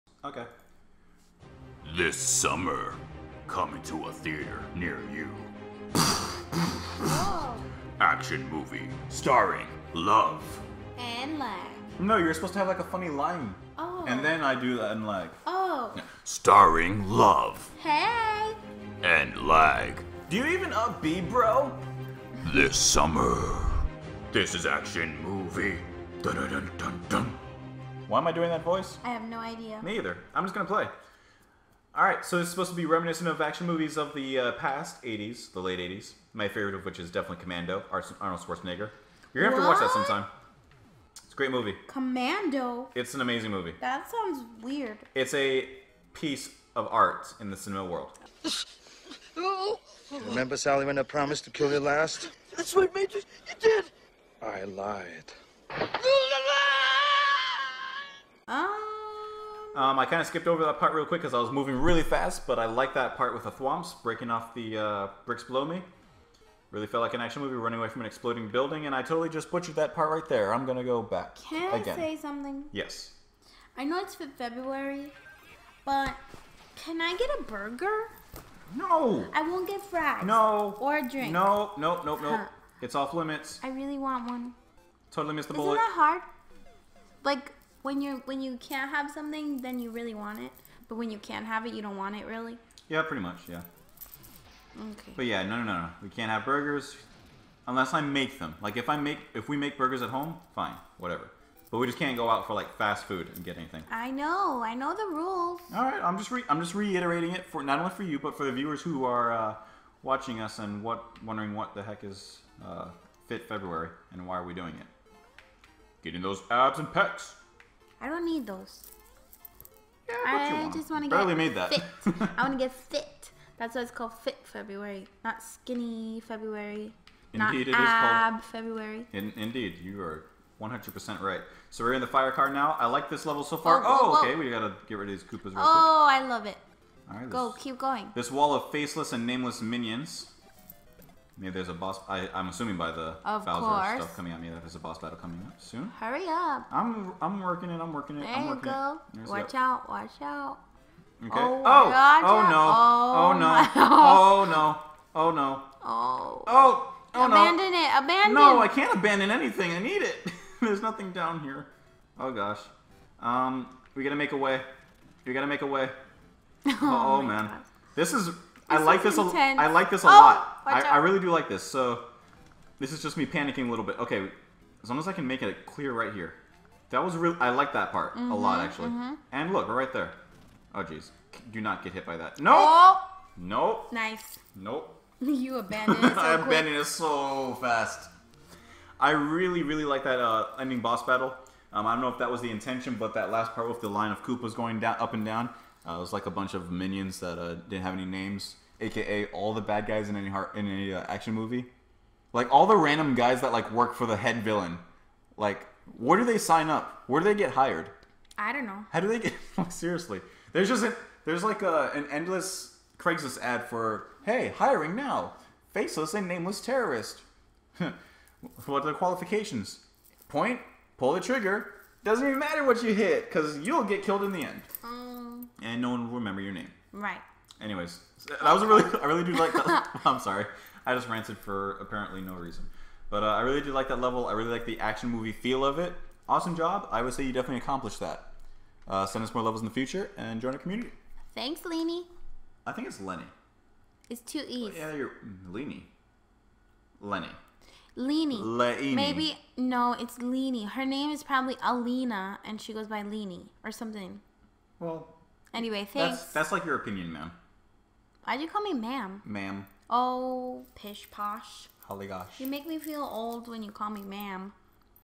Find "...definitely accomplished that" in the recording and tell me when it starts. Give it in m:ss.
3:57.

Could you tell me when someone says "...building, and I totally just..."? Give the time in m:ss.
1:08.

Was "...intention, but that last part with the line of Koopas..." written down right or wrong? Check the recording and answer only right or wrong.
right.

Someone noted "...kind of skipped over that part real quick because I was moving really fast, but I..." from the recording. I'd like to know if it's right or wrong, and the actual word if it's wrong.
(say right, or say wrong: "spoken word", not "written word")
right.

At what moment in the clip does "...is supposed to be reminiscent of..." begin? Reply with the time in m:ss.
0:32.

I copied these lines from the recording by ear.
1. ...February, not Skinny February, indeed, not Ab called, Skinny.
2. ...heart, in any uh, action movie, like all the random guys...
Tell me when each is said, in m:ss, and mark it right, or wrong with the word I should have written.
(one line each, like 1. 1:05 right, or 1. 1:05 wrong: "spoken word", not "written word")
1. 2:04 wrong: "February", not "Skinny"
2. 3:20 right.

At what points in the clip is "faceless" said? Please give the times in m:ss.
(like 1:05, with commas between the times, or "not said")
2:18, 3:35.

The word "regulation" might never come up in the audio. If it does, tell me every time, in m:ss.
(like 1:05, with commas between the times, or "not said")
not said.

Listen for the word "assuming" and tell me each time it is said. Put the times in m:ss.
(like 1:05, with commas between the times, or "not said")
2:22.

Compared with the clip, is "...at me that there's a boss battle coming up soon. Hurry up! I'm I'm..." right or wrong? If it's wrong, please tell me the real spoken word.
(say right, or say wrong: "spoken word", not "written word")
right.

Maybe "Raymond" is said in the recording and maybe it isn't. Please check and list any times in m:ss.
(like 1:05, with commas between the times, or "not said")
not said.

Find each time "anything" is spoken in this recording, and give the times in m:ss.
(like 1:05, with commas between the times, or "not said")
1:43, 2:39.